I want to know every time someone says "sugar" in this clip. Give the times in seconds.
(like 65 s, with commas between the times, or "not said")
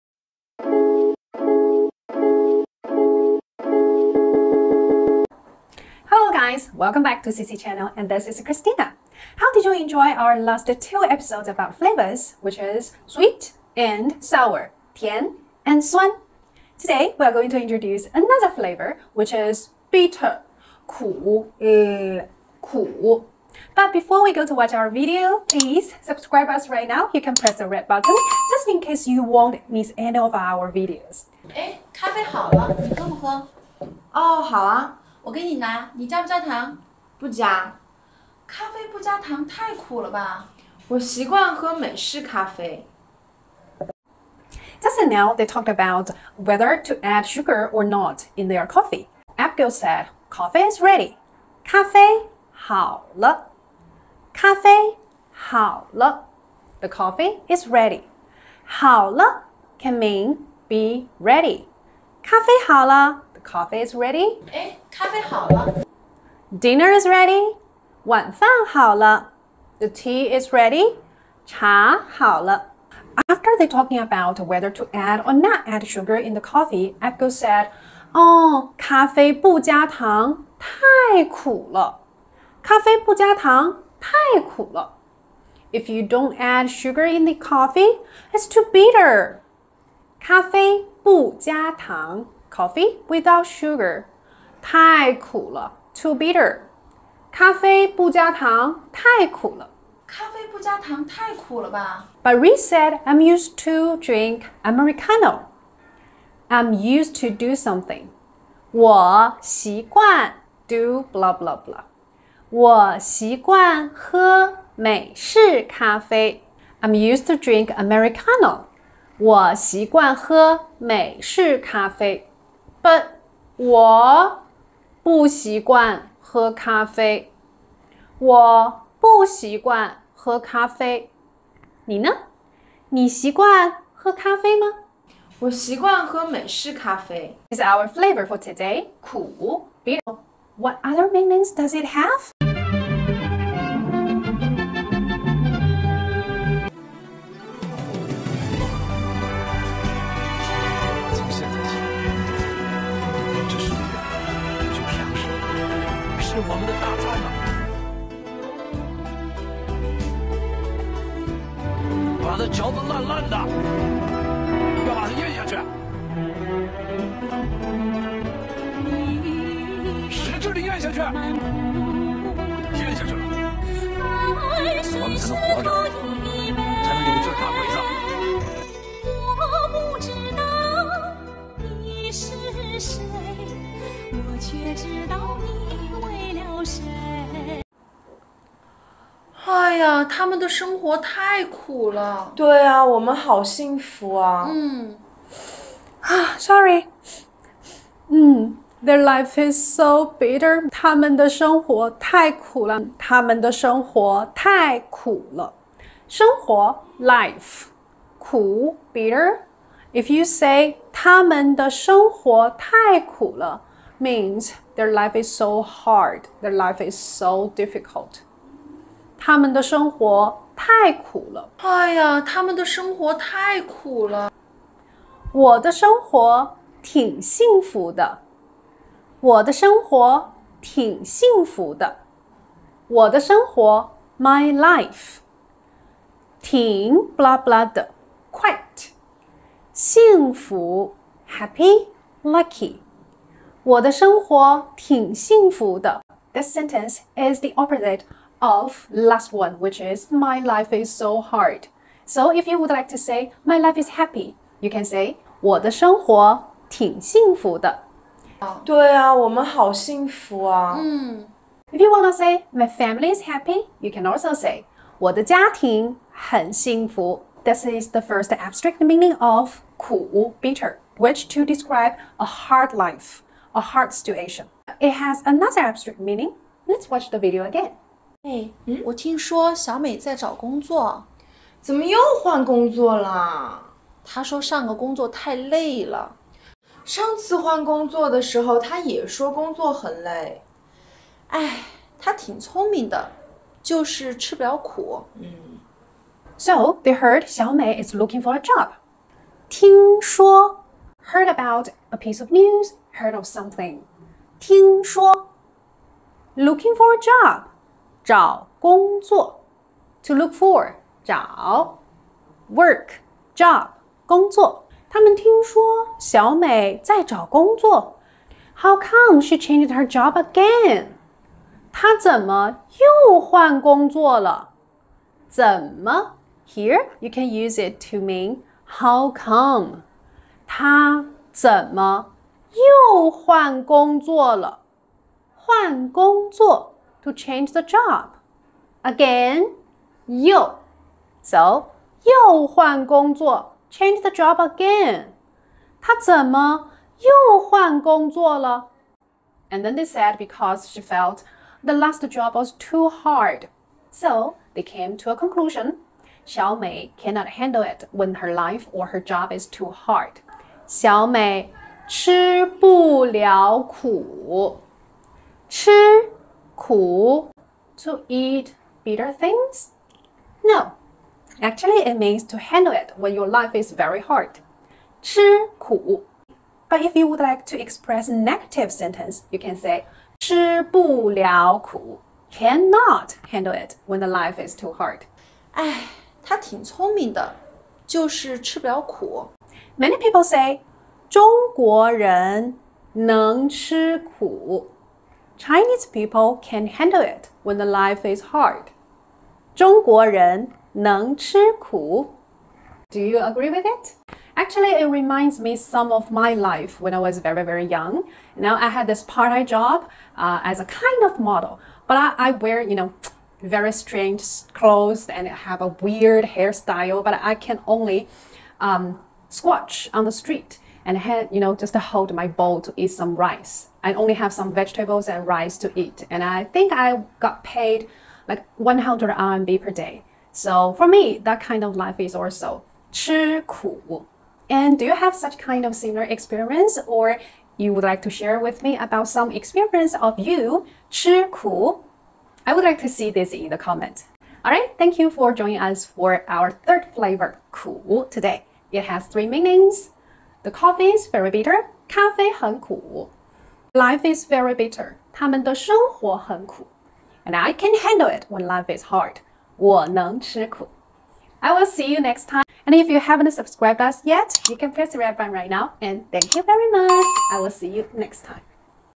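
47 s, 75 s, 86 s, 93 s.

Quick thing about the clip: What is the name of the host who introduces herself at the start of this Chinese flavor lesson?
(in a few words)
Christina.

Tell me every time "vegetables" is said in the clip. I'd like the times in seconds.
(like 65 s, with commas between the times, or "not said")
424 s.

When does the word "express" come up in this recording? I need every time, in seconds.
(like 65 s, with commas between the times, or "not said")
377 s.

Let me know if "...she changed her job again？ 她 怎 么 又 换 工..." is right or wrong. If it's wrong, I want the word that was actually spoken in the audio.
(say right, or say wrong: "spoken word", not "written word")
right.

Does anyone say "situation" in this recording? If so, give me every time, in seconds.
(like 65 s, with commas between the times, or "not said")
273 s.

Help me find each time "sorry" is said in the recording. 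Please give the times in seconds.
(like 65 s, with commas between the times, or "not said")
196 s.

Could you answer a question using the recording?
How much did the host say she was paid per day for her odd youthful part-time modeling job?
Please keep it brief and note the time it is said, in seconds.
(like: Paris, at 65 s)
100 RMB, at 428 s.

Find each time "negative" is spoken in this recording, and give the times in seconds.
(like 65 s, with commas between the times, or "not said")
378 s.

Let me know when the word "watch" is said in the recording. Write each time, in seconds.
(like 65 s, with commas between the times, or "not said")
24 s, 276 s.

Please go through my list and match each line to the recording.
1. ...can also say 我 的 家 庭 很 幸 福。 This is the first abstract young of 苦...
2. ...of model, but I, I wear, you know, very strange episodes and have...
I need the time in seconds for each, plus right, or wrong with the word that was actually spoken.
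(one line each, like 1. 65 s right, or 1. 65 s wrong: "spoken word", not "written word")
1. 263 s wrong: "meaning", not "young"
2. 411 s wrong: "clothes", not "episodes".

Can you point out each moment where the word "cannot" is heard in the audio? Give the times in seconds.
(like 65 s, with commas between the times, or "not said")
356 s, 382 s.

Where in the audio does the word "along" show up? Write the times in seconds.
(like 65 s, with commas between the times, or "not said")
not said.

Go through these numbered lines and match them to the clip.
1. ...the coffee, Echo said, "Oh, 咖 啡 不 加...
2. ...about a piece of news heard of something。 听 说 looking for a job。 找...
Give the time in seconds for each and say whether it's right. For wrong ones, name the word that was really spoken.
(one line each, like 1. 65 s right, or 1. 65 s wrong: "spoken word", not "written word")
1. 76 s right
2. 301 s right.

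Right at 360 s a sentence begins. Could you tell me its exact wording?
小 美 吃 不 了 苦， 吃 cool to eat bitter things?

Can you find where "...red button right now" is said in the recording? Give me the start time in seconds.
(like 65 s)
464 s.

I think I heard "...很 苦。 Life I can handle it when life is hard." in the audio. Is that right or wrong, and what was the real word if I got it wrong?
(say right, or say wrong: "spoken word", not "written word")
wrong: "And", not "Life".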